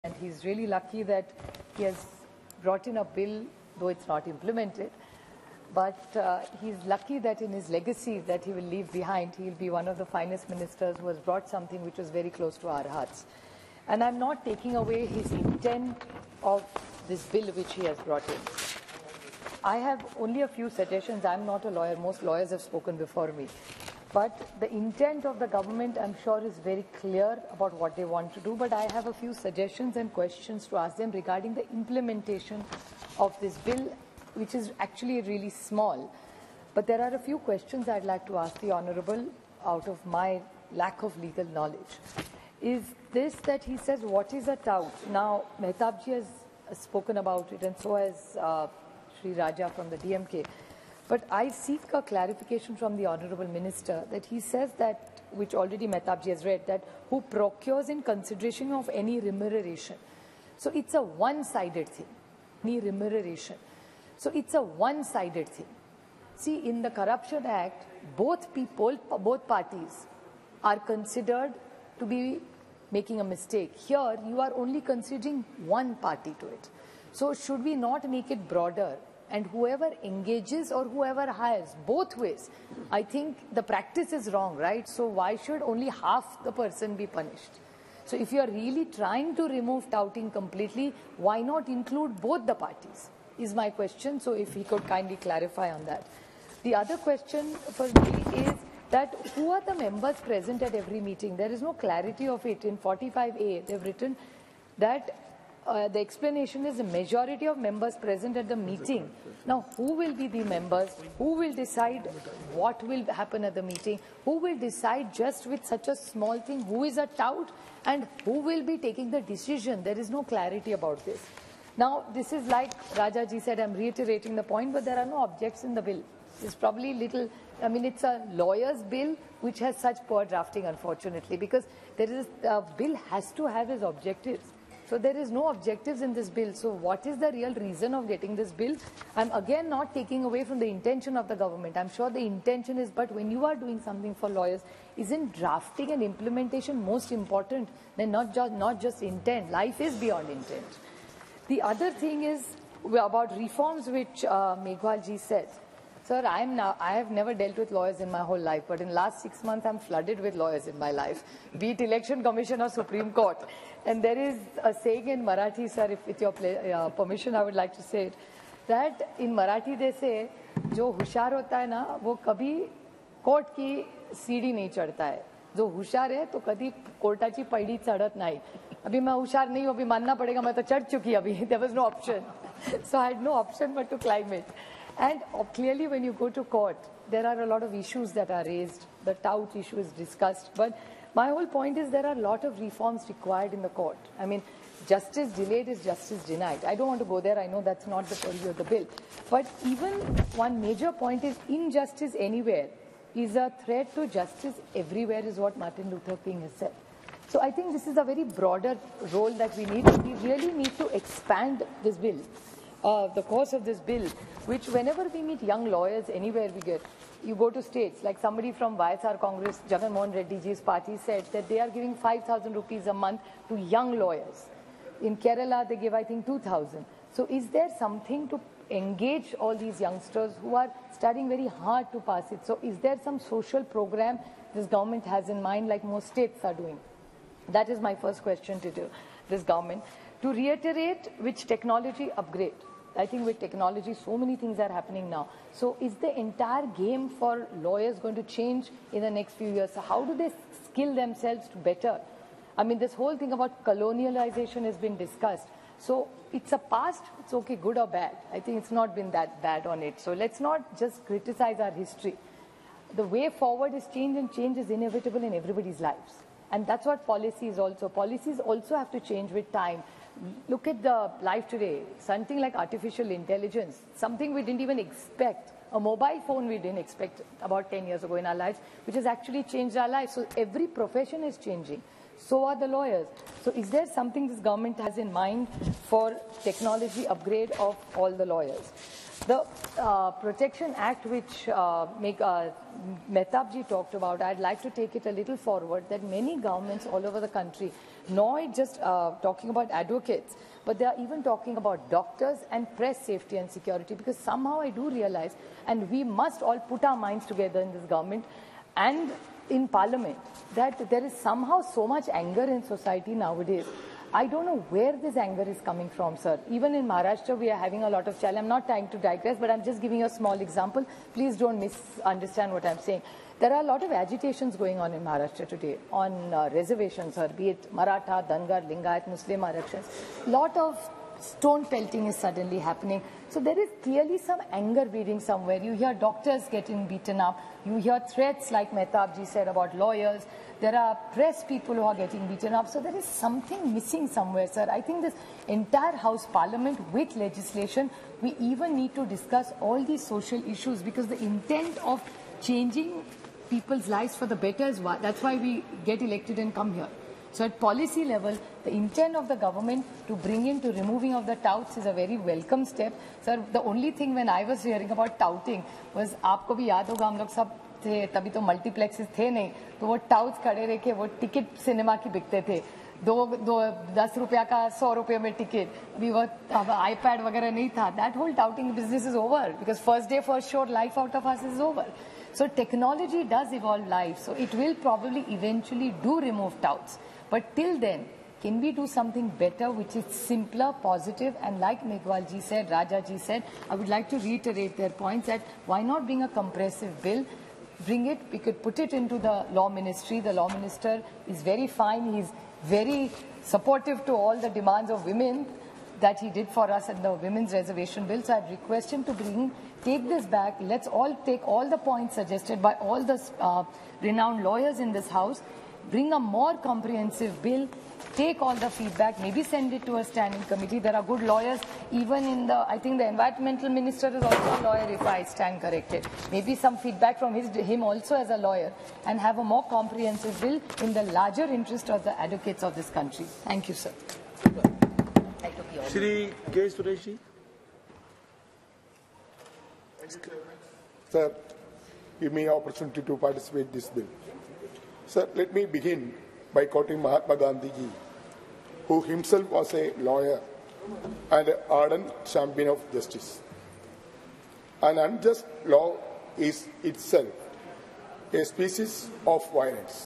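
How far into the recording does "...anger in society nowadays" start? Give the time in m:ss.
5:12.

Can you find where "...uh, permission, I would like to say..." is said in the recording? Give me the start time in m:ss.
2:46.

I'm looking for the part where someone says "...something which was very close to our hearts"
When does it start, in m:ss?
0:11.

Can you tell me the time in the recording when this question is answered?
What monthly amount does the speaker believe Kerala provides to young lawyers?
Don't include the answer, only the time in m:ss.
3:46.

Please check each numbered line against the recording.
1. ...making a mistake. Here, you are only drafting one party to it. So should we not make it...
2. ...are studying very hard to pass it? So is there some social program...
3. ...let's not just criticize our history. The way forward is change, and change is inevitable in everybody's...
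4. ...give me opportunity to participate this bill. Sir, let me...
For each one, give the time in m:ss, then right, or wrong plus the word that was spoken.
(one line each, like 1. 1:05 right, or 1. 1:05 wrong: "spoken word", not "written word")
1. 1:12 wrong: "considering", not "drafting"
2. 3:50 right
3. 4:20 right
4. 7:22 right.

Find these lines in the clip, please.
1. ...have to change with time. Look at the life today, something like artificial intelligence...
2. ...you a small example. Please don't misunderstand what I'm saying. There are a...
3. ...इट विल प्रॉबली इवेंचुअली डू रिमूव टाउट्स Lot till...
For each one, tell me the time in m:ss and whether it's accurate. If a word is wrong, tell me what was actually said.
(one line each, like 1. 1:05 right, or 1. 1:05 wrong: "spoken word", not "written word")
1. 4:28 right
2. 5:19 right
3. 6:24 wrong: "But", not "Lot".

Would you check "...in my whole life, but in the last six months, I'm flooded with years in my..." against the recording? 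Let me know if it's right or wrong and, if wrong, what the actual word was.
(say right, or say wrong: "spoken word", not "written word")
wrong: "lawyers", not "years".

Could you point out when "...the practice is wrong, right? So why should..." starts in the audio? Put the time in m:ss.
1:23.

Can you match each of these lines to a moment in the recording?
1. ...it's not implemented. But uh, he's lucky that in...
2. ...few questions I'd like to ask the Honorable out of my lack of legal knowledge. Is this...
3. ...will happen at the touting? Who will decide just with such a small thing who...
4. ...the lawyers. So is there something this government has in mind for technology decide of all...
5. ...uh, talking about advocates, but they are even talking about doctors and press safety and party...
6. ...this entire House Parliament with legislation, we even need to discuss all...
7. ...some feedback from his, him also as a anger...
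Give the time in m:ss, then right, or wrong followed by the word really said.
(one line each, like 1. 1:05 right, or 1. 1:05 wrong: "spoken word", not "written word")
1. 0:03 right
2. 0:37 right
3. 1:52 wrong: "meeting", not "touting"
4. 4:42 wrong: "upgrade", not "decide"
5. 4:58 wrong: "security", not "party"
6. 5:45 right
7. 7:06 wrong: "lawyer", not "anger".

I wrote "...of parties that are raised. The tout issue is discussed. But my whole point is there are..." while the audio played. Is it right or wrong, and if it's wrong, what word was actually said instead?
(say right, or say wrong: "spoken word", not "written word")
wrong: "issues", not "parties".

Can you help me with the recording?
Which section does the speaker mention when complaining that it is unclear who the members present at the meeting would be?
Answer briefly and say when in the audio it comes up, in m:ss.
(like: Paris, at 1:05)
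45A, at 1:42.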